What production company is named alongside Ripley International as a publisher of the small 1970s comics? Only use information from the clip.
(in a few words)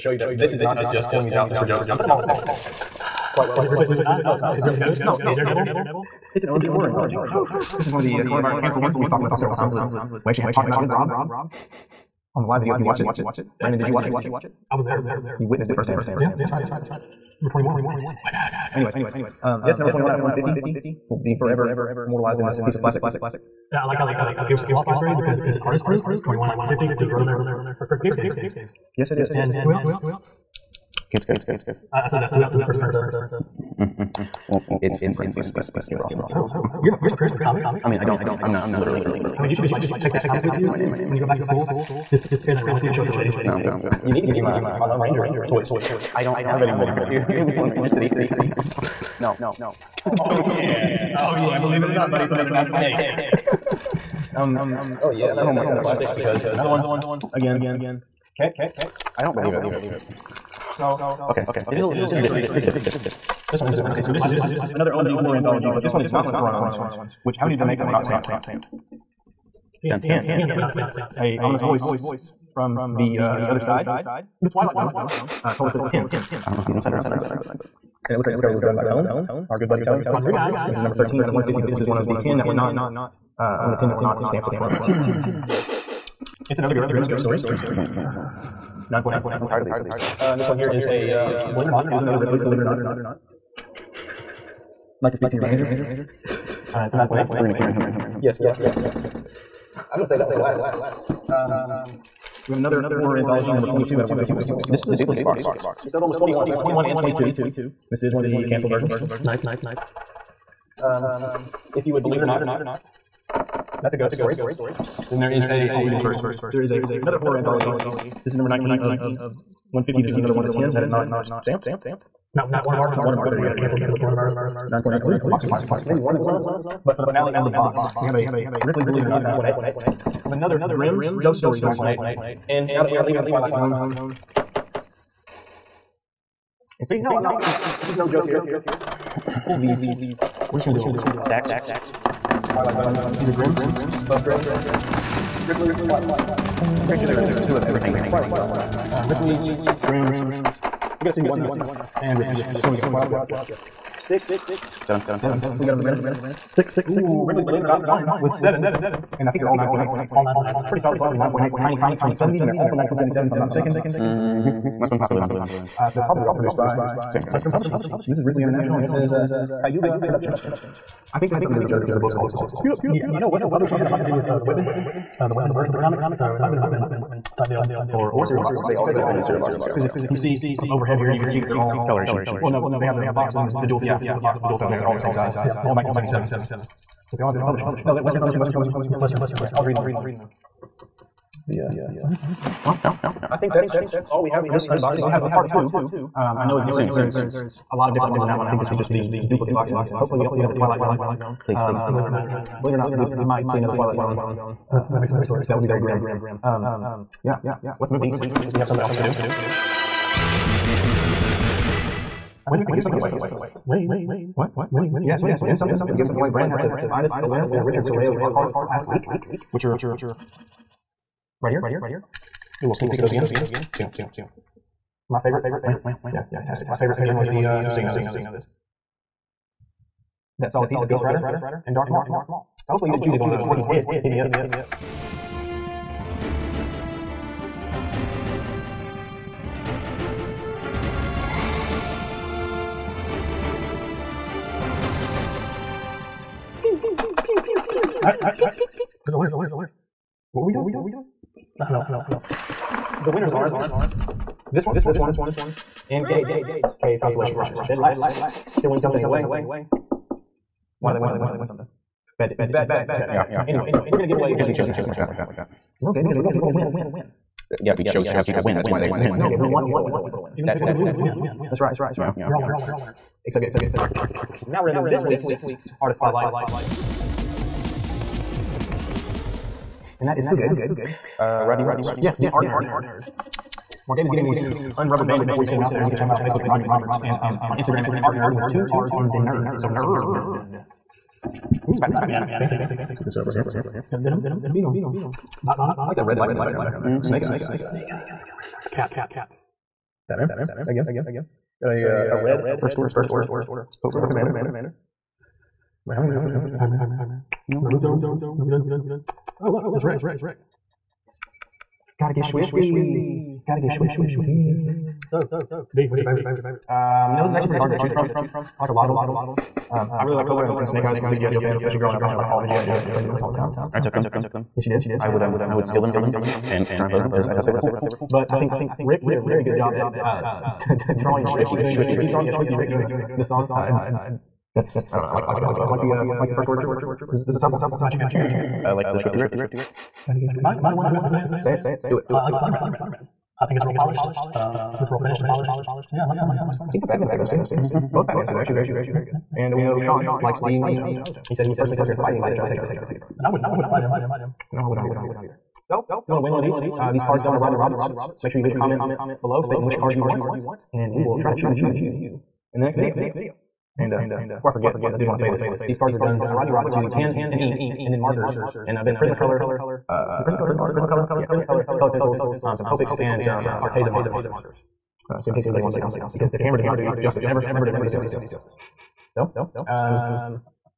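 Cayuga Productions.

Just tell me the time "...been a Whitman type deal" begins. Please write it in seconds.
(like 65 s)
176 s.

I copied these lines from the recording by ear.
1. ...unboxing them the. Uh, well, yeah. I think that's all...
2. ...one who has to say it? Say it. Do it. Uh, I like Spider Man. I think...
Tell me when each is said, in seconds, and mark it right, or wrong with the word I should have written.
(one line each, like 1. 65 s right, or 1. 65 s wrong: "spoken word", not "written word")
1. 189 s wrong: "reading", not "unboxing"
2. 340 s right.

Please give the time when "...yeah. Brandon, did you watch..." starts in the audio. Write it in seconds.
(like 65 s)
13 s.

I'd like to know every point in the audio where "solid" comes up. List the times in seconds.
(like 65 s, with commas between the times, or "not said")
160 s, 230 s.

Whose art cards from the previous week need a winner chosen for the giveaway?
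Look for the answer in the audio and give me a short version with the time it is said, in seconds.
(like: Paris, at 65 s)
Richard Serrayo, at 217 s.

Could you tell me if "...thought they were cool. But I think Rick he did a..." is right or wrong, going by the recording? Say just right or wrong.
right.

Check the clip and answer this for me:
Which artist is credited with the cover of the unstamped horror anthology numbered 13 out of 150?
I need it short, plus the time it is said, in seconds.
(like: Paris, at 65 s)
Tone Rodriguez, at 79 s.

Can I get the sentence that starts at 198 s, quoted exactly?
I think this was just the duplicate box, and hopefully we don't see another Twilight Zone.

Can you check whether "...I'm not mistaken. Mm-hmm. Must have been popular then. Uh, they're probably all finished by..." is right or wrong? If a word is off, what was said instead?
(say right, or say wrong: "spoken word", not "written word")
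wrong: "produced", not "finished".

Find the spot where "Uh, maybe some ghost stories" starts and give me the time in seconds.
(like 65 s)
204 s.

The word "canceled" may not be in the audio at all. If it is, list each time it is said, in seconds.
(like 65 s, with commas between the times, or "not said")
8 s, 108 s, 123 s.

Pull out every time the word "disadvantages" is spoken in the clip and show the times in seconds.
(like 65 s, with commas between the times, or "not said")
not said.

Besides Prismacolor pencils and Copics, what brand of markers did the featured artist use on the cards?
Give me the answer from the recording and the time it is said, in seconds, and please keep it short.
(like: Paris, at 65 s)
Arteza, at 373 s.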